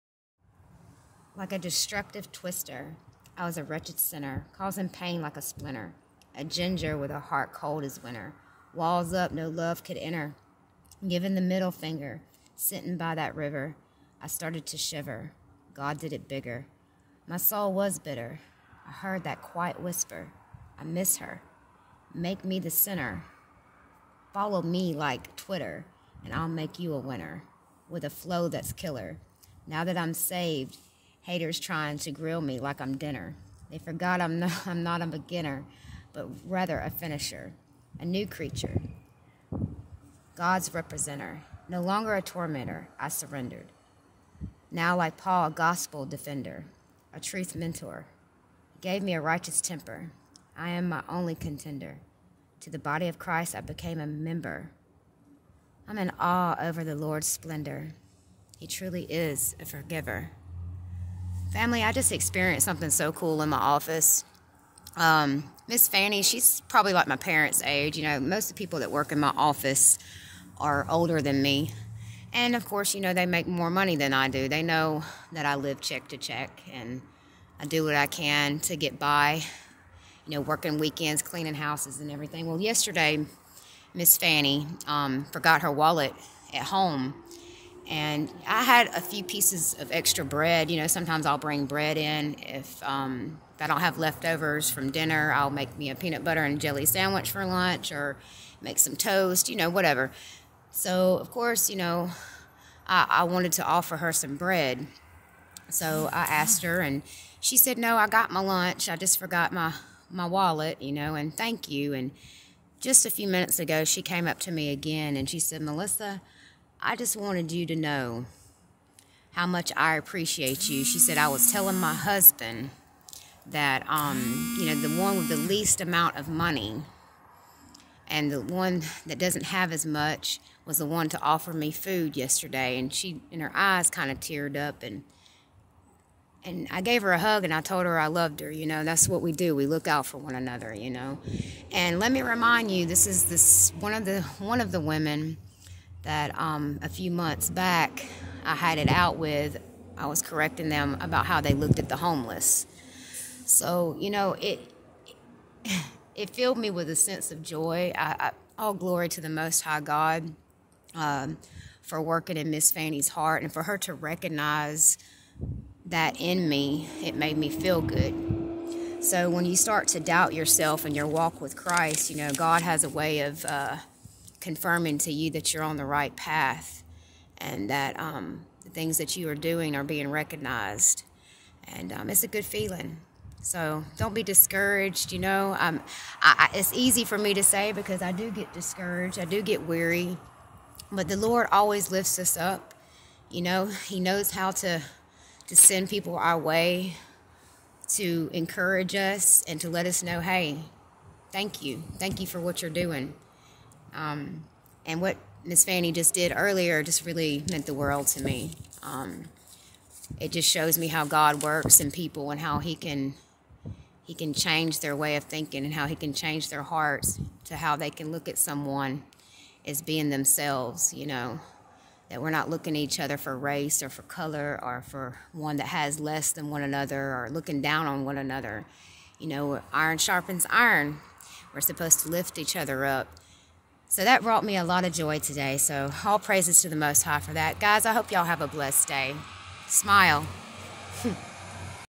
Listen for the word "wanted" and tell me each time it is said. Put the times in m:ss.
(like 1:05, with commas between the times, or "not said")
1:43, 1:57.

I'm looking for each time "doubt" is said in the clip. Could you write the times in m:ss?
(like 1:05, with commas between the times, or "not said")
2:49.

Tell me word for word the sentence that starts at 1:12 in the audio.
And of course, you know, they make more money than I do.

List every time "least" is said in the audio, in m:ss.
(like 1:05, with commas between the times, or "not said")
2:05.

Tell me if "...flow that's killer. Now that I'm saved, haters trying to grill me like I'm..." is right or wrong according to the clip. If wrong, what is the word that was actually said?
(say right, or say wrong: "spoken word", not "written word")
right.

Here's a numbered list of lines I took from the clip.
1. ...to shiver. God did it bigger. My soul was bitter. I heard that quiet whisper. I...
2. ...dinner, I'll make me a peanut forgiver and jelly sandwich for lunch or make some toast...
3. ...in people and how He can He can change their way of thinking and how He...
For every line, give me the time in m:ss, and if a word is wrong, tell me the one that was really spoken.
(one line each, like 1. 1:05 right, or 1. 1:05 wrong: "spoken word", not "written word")
1. 0:14 right
2. 1:34 wrong: "butter", not "forgiver"
3. 3:31 right.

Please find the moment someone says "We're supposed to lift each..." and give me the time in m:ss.
3:51.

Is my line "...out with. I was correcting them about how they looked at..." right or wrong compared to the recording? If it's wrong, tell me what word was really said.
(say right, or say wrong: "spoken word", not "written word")
right.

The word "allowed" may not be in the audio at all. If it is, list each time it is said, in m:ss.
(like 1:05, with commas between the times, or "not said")
not said.